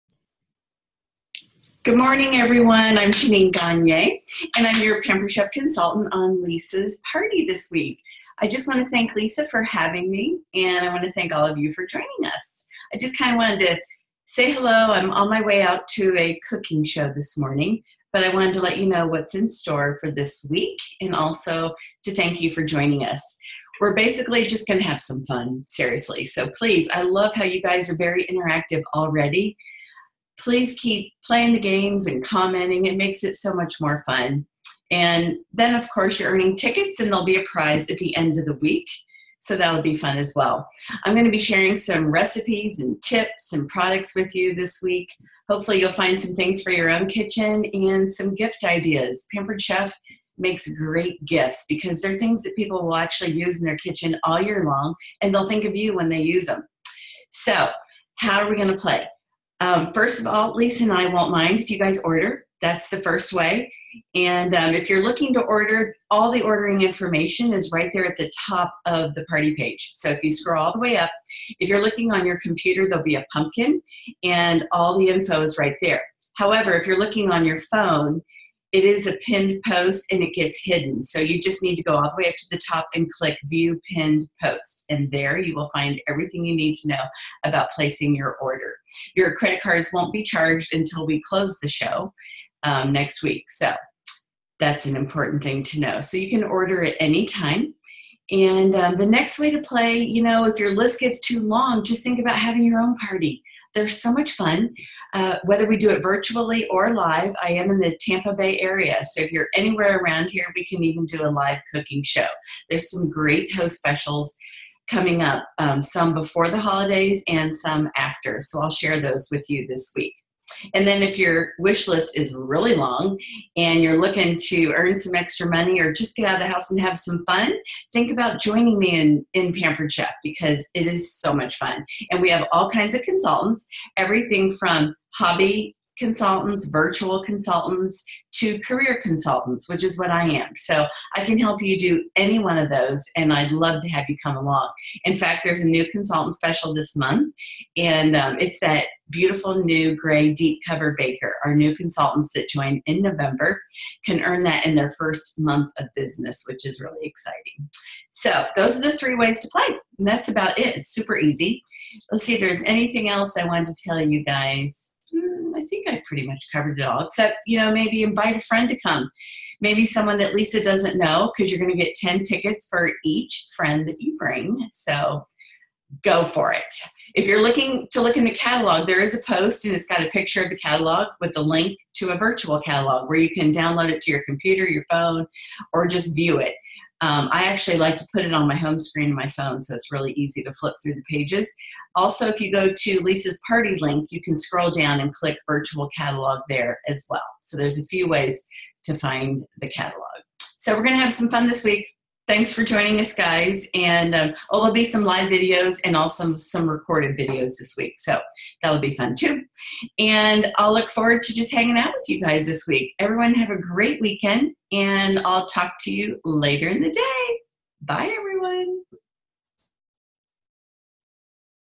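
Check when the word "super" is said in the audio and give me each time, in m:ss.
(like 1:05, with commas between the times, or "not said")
2:40.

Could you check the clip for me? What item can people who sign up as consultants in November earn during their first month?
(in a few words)
gray deep cover baker.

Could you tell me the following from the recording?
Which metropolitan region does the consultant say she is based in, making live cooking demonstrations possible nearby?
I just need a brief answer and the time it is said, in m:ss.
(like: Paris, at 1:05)
Tampa Bay, at 1:47.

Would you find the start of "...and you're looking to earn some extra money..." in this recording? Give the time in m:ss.
2:03.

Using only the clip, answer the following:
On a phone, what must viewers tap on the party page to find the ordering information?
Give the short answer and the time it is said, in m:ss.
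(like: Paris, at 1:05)
View Pinned Post, at 1:23.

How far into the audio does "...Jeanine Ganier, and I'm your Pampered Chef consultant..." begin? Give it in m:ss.
0:03.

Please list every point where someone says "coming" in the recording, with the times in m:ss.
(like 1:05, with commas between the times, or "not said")
1:54.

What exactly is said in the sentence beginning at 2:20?
So I can help you do any one of those, and I'd love to have you come along.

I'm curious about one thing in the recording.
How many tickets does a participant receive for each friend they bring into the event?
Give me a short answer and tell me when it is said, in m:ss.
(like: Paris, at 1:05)
10, at 2:51.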